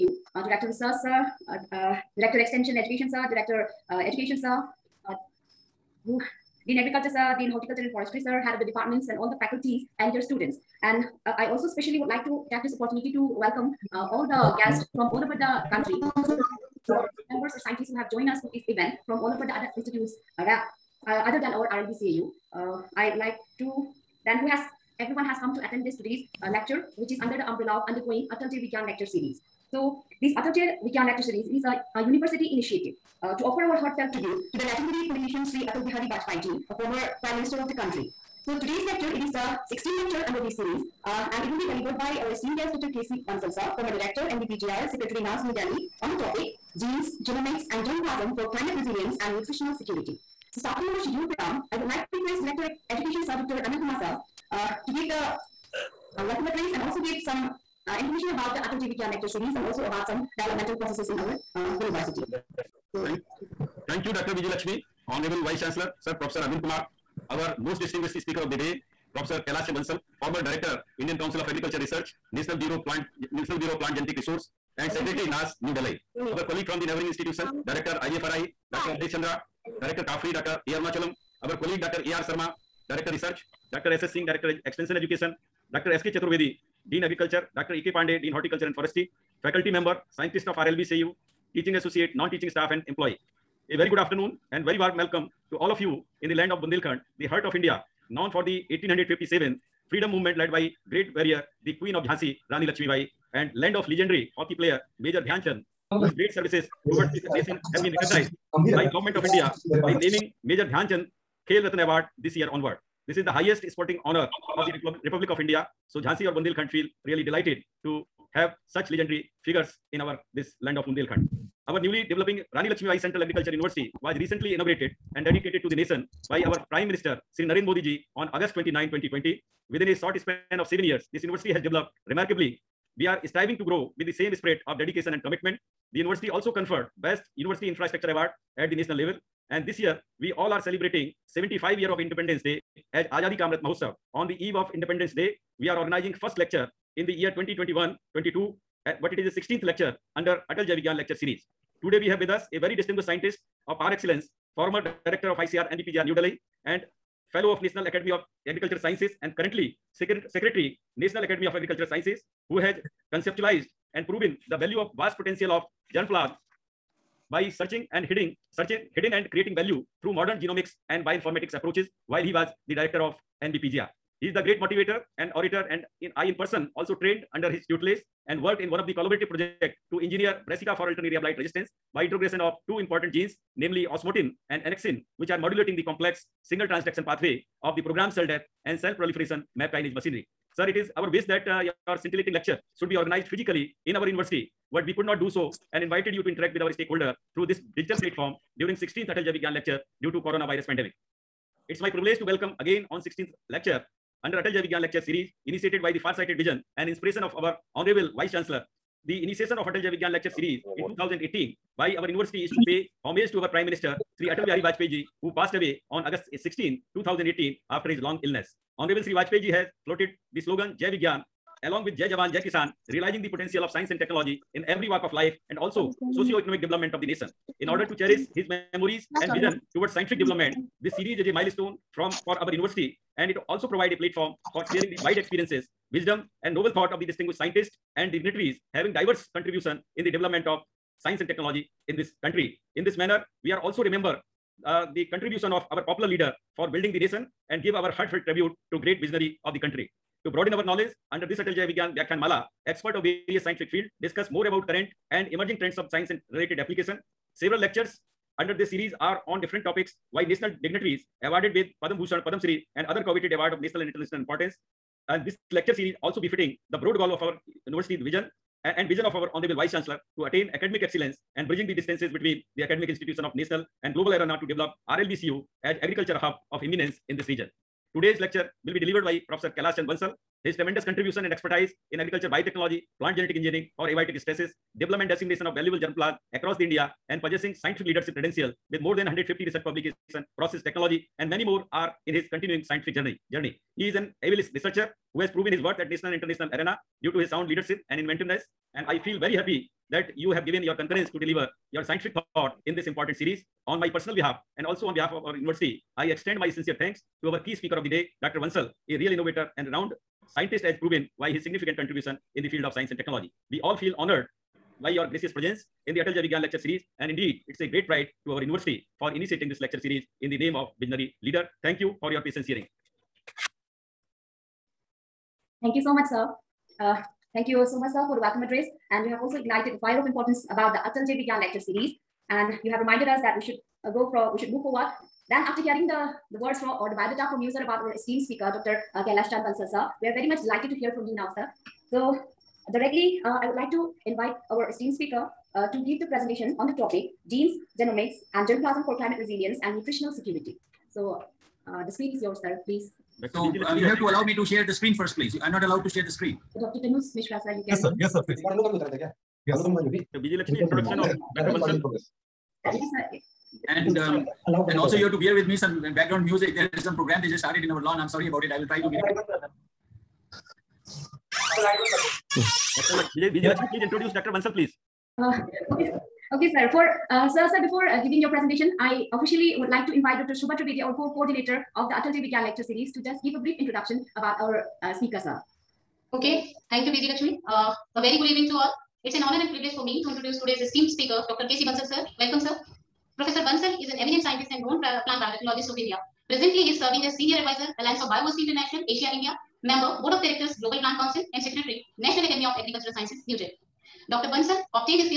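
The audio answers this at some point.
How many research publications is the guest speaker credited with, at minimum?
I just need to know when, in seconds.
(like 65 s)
289 s.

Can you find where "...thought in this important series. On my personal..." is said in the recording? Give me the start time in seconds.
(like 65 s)
302 s.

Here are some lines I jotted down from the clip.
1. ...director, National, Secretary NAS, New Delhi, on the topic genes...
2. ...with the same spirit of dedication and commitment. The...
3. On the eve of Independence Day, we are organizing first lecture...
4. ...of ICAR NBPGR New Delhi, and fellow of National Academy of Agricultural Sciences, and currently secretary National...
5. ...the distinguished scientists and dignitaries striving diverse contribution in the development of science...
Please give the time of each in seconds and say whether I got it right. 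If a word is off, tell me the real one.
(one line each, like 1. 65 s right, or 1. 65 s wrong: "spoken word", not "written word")
1. 43 s wrong: "NBPGR", not "National"
2. 133 s right
3. 144 s right
4. 155 s right
5. 237 s wrong: "having", not "striving".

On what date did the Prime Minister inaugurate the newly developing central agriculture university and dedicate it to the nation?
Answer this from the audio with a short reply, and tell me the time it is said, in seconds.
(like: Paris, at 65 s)
August 29, 2020, at 128 s.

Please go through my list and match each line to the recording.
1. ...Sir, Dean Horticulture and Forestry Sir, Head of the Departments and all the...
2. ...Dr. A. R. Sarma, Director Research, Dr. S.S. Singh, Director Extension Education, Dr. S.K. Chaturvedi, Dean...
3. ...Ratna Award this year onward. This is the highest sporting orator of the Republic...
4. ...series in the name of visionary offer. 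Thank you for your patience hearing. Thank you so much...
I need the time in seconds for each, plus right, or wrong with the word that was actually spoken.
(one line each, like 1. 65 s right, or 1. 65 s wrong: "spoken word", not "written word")
1. 7 s right
2. 81 s right
3. 111 s wrong: "honor", not "orator"
4. 319 s wrong: "leader", not "offer".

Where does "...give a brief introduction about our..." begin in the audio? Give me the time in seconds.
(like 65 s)
383 s.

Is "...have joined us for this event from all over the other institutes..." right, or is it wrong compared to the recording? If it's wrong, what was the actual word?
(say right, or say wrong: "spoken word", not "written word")
right.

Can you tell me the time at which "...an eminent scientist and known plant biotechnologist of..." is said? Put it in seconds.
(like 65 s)
393 s.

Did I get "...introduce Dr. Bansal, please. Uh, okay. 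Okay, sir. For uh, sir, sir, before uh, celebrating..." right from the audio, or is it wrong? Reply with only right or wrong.
wrong.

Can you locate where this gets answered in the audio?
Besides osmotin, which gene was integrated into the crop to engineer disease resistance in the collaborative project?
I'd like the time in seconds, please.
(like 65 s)
184 s.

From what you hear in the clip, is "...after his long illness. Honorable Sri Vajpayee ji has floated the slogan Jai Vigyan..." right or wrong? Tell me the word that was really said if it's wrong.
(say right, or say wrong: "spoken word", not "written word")
right.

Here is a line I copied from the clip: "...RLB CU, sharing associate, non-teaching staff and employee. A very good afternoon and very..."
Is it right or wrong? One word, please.
wrong.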